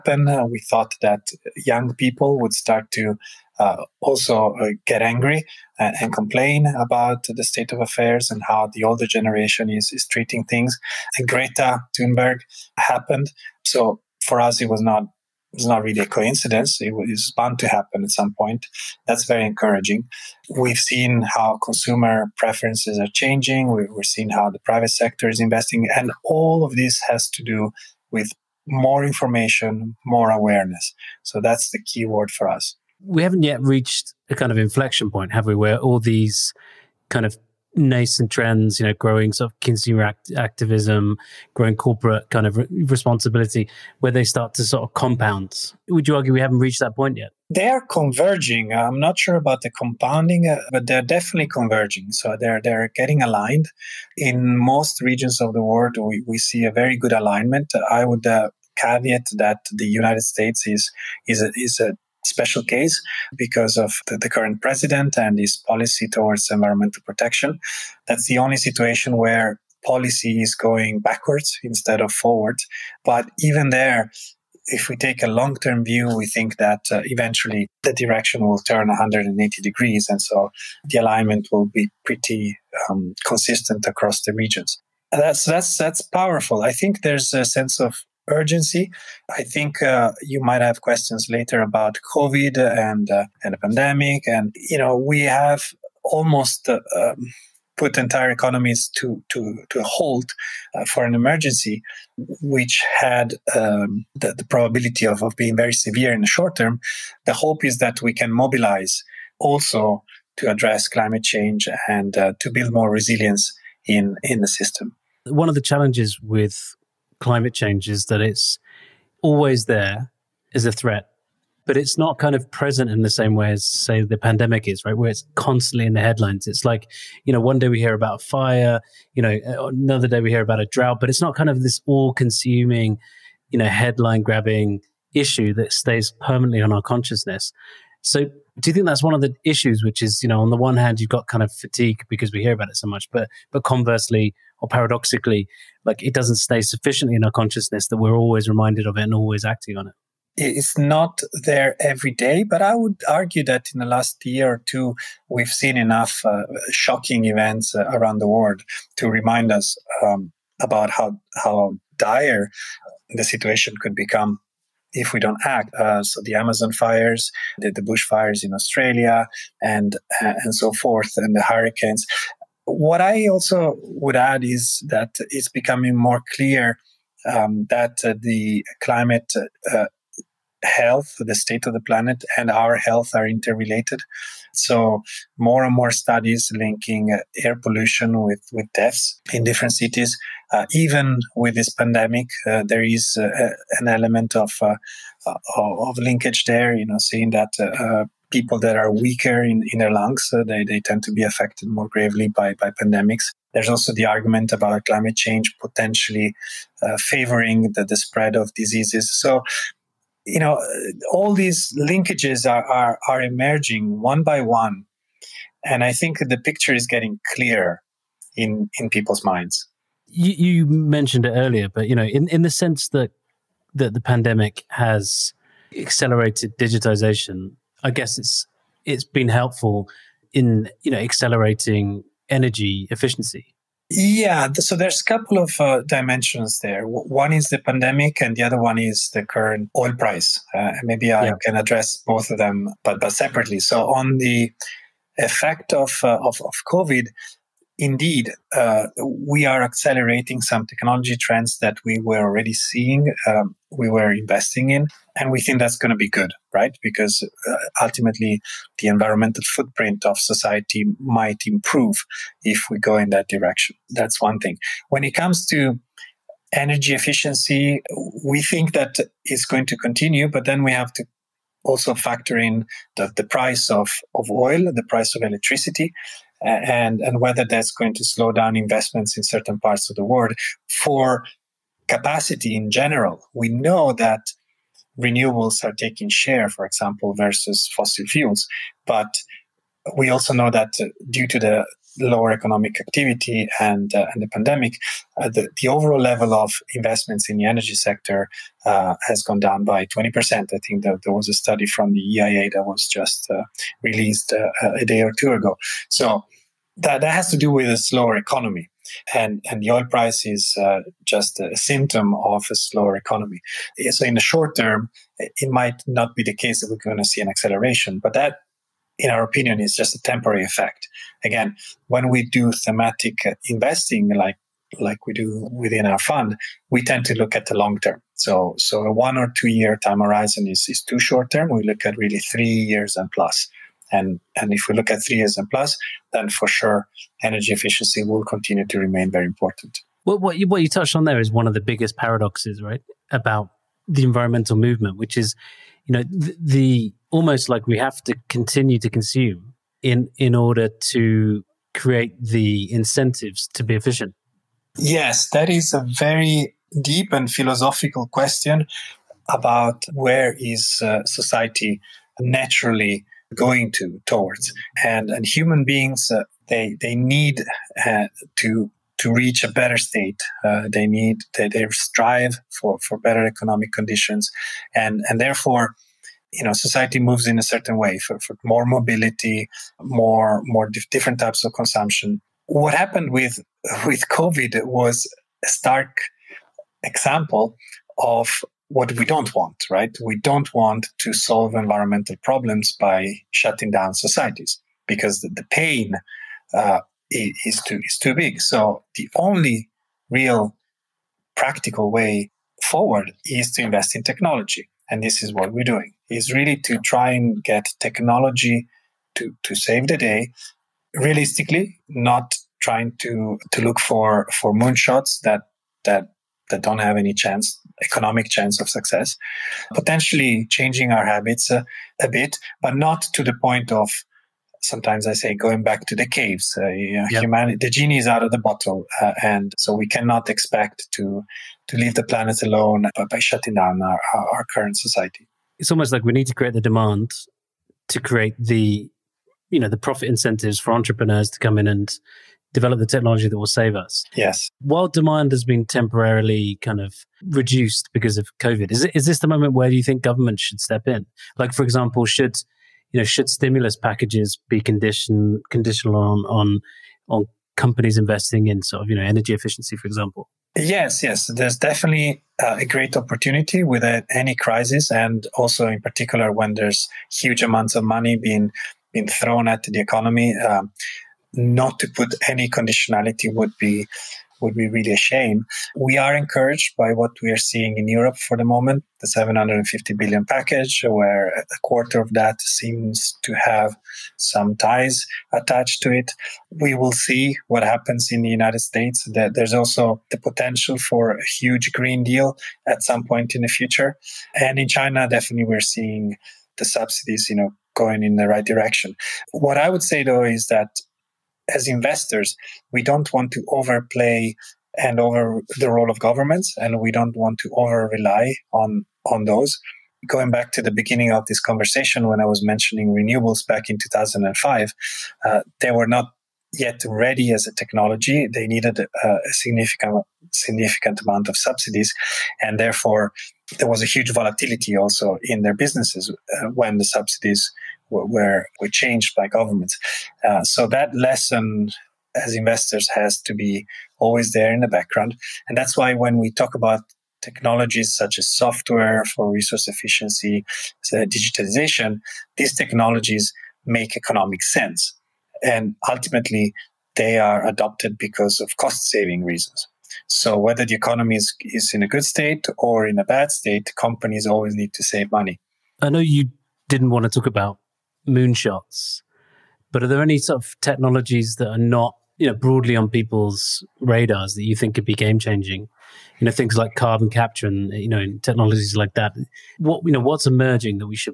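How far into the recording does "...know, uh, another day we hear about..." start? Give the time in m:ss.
2:09.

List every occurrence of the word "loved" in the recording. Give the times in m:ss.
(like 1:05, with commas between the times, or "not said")
not said.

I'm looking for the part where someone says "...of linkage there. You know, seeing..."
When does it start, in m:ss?
3:15.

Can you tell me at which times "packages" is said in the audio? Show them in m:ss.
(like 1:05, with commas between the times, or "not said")
7:33, 8:00.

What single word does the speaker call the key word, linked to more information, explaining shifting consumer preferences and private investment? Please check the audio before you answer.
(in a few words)
awareness.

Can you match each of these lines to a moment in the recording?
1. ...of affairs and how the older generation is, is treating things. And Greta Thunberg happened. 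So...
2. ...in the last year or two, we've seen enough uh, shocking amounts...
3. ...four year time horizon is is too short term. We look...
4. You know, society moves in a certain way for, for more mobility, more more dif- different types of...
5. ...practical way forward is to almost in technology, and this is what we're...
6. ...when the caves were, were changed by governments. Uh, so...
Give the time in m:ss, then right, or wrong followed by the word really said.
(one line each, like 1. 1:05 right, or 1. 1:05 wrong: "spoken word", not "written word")
1. 0:07 right
2. 2:33 wrong: "events", not "amounts"
3. 5:29 wrong: "two", not "four"
4. 6:16 right
5. 6:41 wrong: "invest", not "almost"
6. 8:46 wrong: "subsidies", not "caves".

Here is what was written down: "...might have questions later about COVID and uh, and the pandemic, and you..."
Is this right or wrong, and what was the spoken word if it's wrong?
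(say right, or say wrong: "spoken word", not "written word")
right.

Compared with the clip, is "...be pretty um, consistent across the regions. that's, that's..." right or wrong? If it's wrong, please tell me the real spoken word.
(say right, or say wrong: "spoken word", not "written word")
right.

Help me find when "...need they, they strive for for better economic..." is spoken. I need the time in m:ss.
6:10.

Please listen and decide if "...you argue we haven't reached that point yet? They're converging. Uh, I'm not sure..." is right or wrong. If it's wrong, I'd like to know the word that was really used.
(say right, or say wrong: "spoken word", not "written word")
right.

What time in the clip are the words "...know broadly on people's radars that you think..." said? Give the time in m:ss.
9:22.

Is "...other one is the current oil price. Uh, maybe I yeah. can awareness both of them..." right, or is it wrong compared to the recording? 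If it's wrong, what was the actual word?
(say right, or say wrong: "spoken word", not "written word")
wrong: "address", not "awareness".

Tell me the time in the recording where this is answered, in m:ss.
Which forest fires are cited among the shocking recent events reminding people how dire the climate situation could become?
2:46.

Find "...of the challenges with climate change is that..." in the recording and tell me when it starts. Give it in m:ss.
1:55.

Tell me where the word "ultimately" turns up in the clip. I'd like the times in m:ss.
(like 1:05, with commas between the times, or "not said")
4:17, 9:05.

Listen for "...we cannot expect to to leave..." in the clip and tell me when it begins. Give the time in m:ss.
7:09.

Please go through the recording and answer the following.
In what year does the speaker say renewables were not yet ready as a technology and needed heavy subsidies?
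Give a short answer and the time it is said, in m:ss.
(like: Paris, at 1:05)
2005, at 8:33.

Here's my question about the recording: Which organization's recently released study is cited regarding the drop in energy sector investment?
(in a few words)
EIA.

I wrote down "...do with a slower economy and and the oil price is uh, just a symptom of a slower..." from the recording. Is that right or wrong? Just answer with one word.
right.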